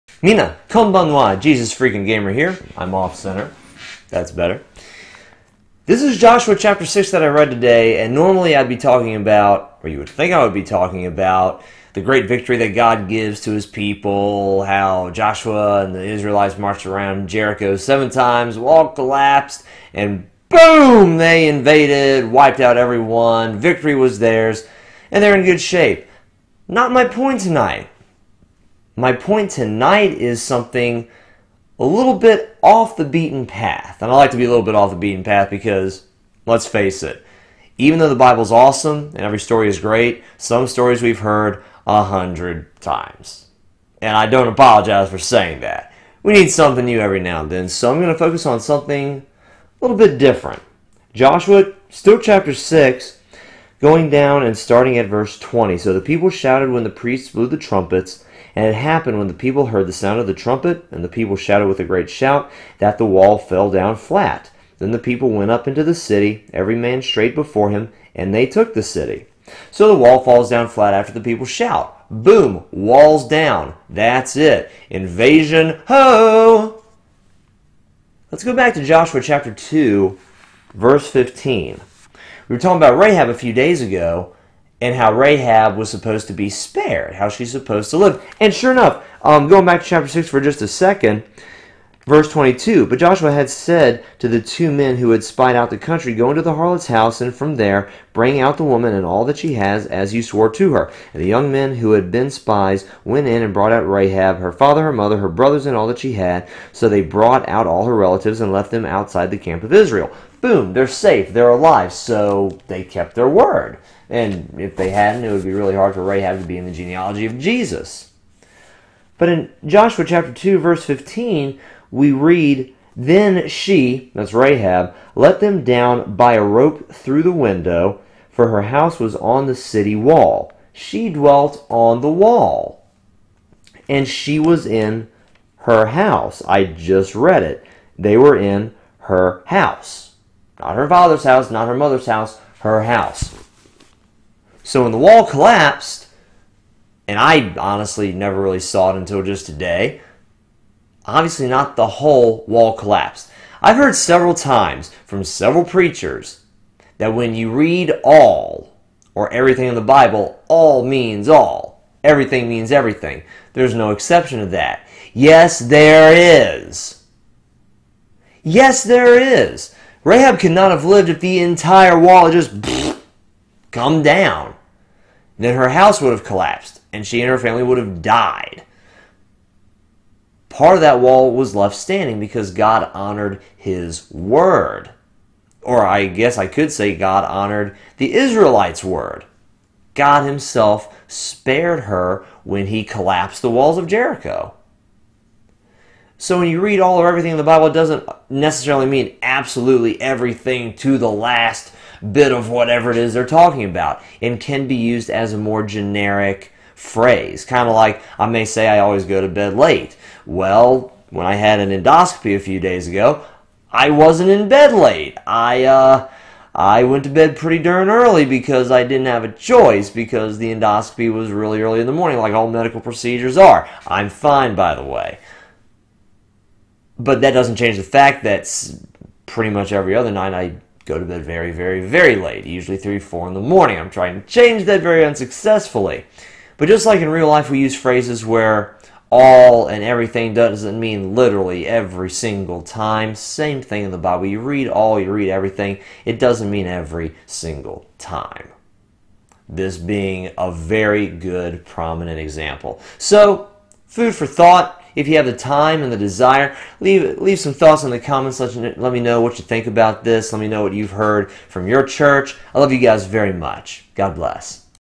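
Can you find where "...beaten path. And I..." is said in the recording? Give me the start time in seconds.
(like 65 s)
33 s.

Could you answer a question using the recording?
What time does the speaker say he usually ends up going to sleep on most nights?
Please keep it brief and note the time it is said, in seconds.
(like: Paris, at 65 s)
3 or 4 in the morning, at 232 s.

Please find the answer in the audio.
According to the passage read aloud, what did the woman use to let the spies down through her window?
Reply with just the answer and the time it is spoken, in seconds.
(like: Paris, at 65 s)
A rope, at 126 s.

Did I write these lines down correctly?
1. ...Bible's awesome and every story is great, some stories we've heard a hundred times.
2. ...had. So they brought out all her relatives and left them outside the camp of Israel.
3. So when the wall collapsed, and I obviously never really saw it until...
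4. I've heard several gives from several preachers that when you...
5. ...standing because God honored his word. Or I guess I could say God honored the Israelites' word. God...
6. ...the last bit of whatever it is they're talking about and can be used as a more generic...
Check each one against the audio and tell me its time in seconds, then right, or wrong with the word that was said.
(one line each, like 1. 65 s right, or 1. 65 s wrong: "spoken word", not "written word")
1. 38 s right
2. 106 s right
3. 144 s wrong: "honestly", not "obviously"
4. 153 s wrong: "times", not "gives"
5. 181 s right
6. 200 s right.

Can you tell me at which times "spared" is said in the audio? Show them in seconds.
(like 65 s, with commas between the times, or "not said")
86 s, 191 s.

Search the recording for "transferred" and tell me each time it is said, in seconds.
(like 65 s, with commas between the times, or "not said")
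not said.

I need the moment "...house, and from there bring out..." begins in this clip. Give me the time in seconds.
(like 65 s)
96 s.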